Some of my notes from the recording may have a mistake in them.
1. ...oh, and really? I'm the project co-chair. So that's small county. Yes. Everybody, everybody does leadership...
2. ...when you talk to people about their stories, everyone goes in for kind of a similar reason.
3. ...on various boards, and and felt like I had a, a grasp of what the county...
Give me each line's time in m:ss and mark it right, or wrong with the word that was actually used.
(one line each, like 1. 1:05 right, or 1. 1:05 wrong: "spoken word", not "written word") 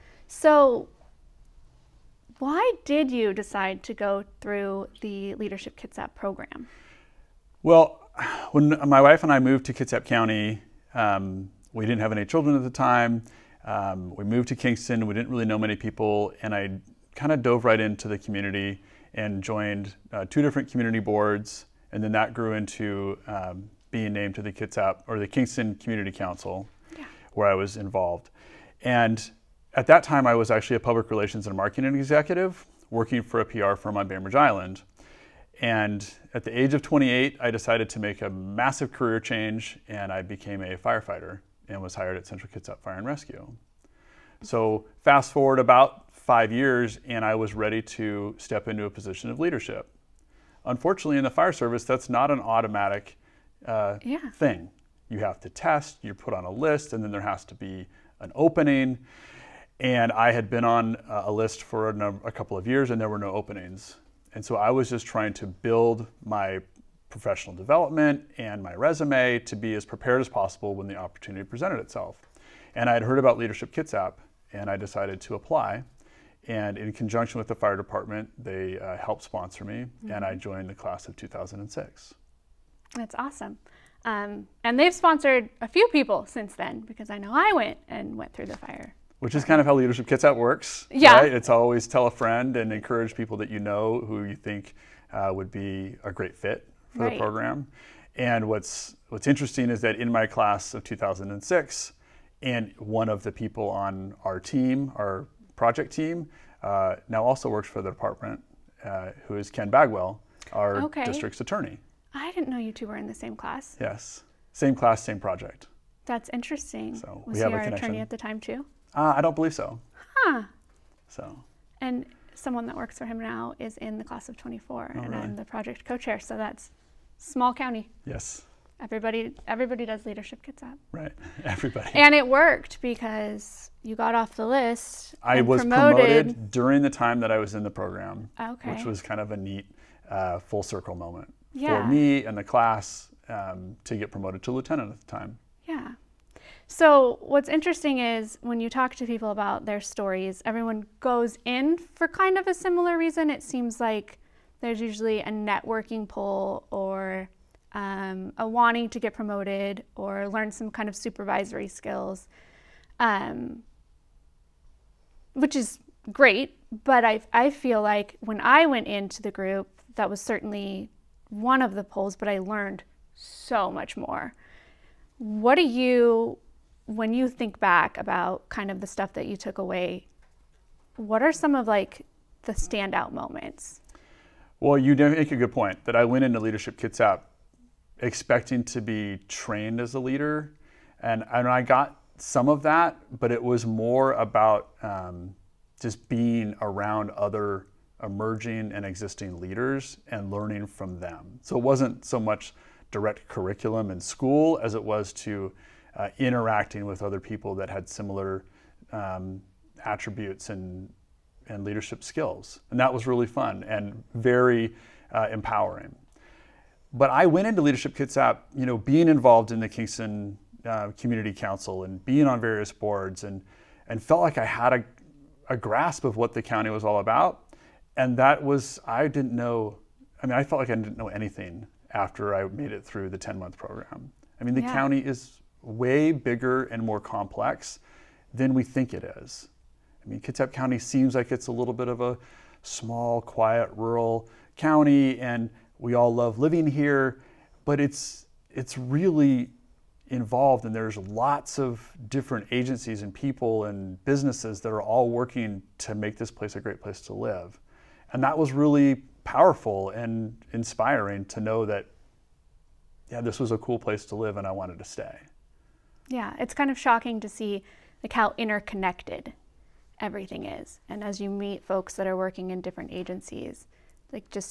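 1. 2:04 right
2. 2:28 right
3. 3:42 right.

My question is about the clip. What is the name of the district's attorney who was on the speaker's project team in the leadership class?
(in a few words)
Ken Bagwell.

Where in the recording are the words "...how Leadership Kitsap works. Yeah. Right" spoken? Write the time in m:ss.
1:29.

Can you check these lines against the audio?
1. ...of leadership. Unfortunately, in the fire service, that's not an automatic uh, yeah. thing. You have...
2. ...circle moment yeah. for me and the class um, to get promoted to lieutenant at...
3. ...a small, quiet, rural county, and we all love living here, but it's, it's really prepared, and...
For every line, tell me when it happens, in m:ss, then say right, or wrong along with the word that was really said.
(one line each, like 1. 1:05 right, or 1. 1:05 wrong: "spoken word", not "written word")
1. 0:49 right
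2. 2:20 right
3. 4:02 wrong: "involved", not "prepared".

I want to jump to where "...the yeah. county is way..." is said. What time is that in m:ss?
3:54.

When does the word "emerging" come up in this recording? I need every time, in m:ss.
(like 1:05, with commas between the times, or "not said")
3:18.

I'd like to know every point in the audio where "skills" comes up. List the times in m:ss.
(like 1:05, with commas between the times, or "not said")
2:41, 3:32.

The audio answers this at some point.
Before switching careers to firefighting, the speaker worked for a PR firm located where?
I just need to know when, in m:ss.
0:34.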